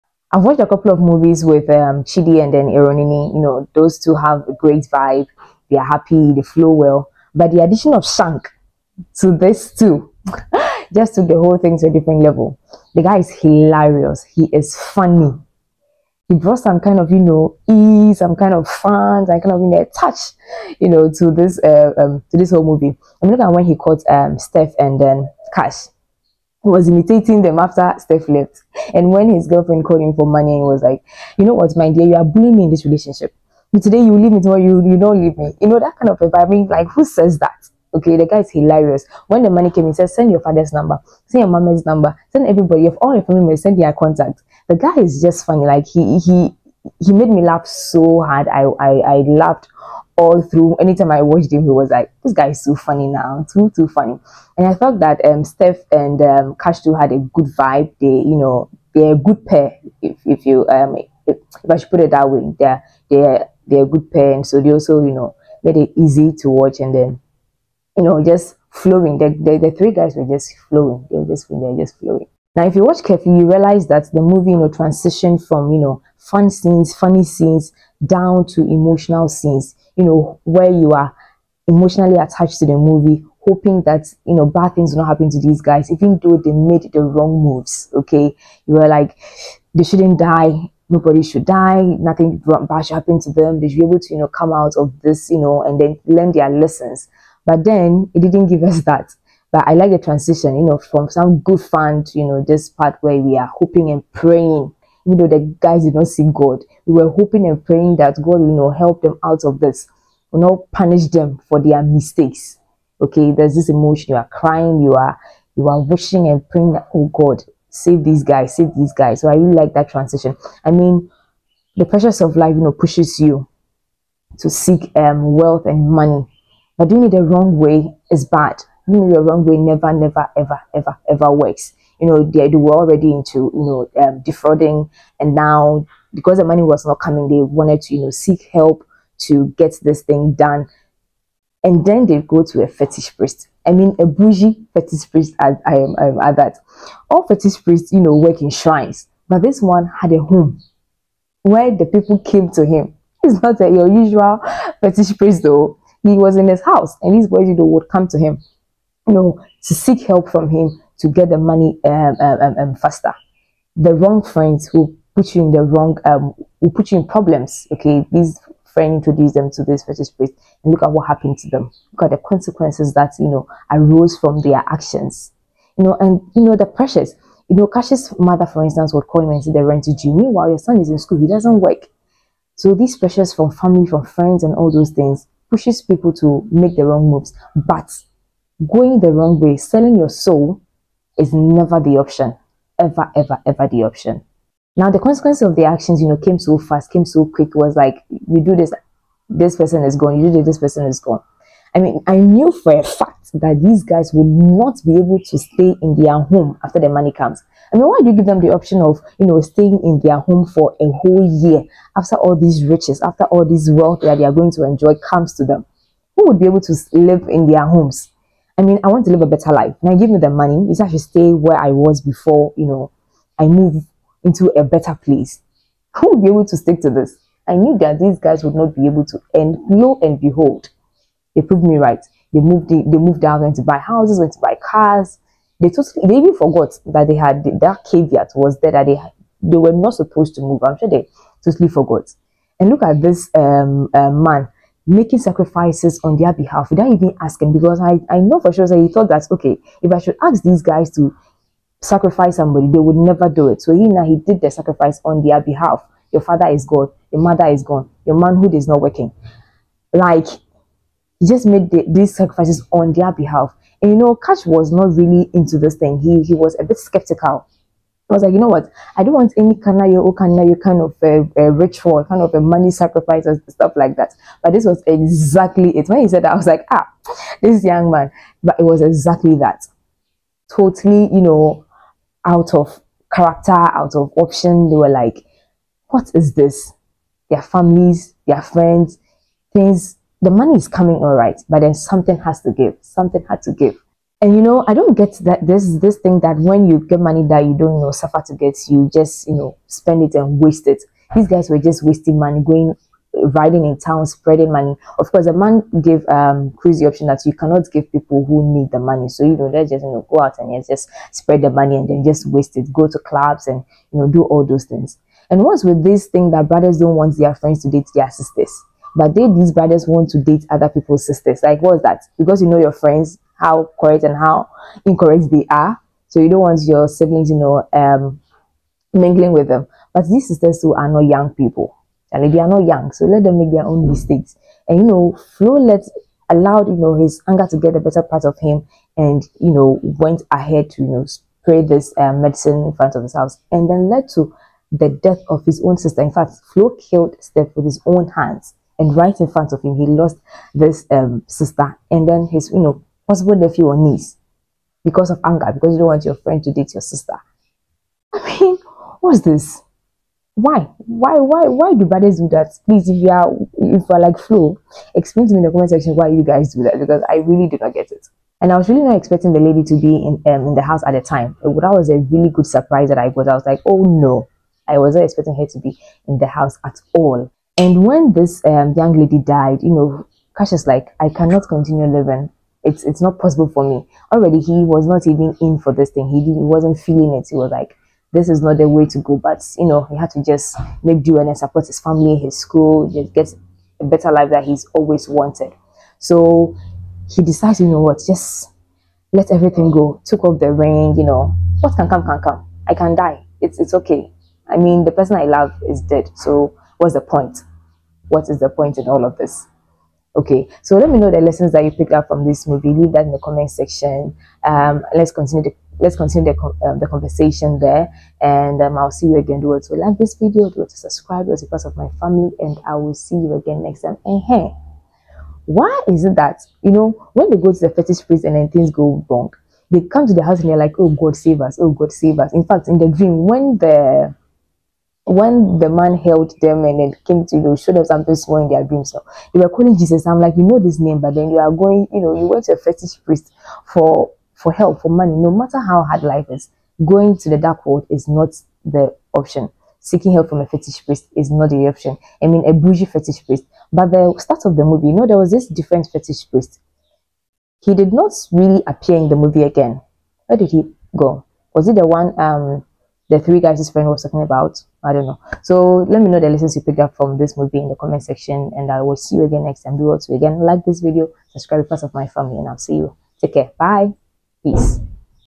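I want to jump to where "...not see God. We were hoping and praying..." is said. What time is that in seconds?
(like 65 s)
105 s.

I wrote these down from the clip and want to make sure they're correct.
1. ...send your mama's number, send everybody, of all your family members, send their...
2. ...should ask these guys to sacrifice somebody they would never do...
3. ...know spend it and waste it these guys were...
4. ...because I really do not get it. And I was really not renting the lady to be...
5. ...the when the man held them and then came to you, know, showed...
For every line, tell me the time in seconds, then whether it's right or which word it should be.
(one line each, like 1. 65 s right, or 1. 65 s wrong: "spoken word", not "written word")
1. 41 s right
2. 249 s right
3. 299 s right
4. 366 s wrong: "expecting", not "renting"
5. 433 s right.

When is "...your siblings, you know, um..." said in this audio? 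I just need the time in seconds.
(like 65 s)
326 s.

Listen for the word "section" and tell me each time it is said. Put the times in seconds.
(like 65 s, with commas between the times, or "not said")
365 s, 413 s, 468 s.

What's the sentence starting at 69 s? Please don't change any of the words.
The the, the three guys were just flowing.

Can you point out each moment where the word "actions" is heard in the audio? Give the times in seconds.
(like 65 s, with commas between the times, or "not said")
174 s, 195 s.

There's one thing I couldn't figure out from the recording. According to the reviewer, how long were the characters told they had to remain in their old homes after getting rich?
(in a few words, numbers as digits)
a whole year.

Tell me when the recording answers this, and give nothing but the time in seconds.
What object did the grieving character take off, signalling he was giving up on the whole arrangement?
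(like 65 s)
400 s.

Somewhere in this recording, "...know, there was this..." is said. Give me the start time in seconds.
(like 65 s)
454 s.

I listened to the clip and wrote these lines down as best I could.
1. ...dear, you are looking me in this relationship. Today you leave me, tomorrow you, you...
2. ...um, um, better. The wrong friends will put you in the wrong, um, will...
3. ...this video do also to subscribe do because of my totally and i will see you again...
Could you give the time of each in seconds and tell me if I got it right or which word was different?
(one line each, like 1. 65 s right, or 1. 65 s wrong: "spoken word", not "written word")
1. 31 s wrong: "bullying", not "looking"
2. 162 s wrong: "faster", not "better"
3. 419 s wrong: "family", not "totally".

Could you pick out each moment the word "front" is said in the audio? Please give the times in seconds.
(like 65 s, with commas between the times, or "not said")
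342 s, 349 s.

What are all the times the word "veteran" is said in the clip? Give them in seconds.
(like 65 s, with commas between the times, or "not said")
not said.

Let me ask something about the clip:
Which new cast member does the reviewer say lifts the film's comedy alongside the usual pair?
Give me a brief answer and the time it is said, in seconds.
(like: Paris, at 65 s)
Shank, at 8 s.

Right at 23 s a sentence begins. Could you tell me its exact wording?
I'm mean, looking at when he caught um, Steph and then Cash was imitating them after Steph left.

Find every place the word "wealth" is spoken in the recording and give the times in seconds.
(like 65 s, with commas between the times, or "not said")
125 s, 213 s.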